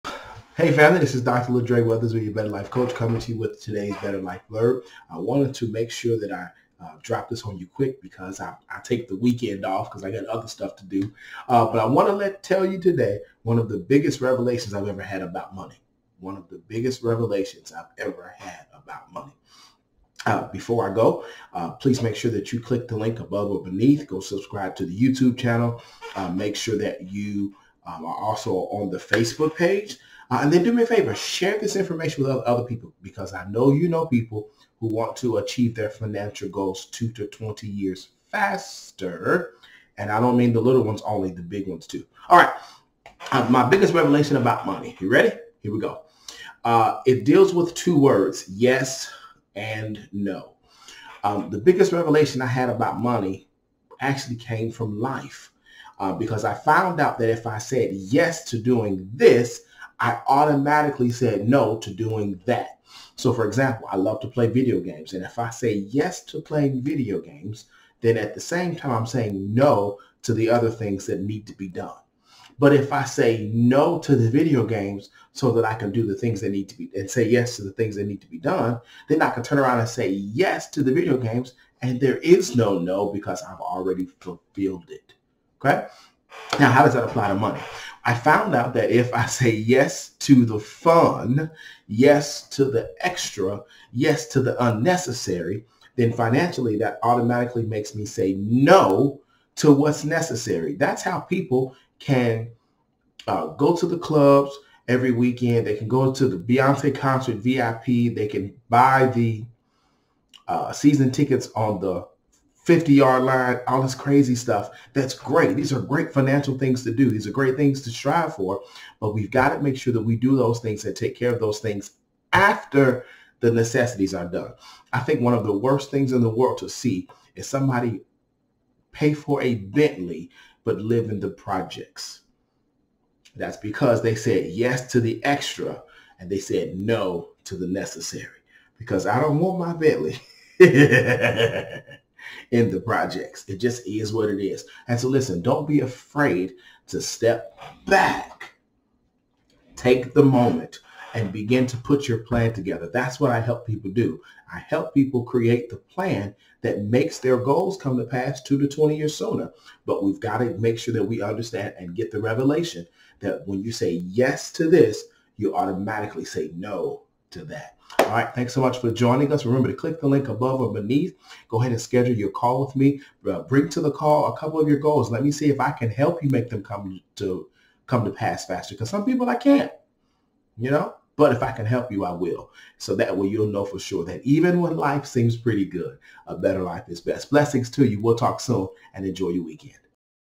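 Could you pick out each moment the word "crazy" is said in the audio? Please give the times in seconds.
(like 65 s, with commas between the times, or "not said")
113 s.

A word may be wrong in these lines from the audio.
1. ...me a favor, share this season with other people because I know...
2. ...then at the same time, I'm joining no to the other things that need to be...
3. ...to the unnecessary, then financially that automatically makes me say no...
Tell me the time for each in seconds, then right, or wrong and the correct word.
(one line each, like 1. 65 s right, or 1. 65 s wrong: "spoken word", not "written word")
1. 30 s wrong: "information", not "season"
2. 68 s wrong: "saying", not "joining"
3. 94 s right.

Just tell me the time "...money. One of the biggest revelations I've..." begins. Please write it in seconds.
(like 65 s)
15 s.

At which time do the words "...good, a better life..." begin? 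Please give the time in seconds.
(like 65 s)
185 s.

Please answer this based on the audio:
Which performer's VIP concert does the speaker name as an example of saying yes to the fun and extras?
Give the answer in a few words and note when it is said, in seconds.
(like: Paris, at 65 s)
Beyonce, at 106 s.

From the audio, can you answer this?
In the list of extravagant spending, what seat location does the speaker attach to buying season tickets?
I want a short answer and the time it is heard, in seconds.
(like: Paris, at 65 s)
50 yard line, at 112 s.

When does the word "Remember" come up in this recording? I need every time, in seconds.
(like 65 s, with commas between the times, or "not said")
169 s.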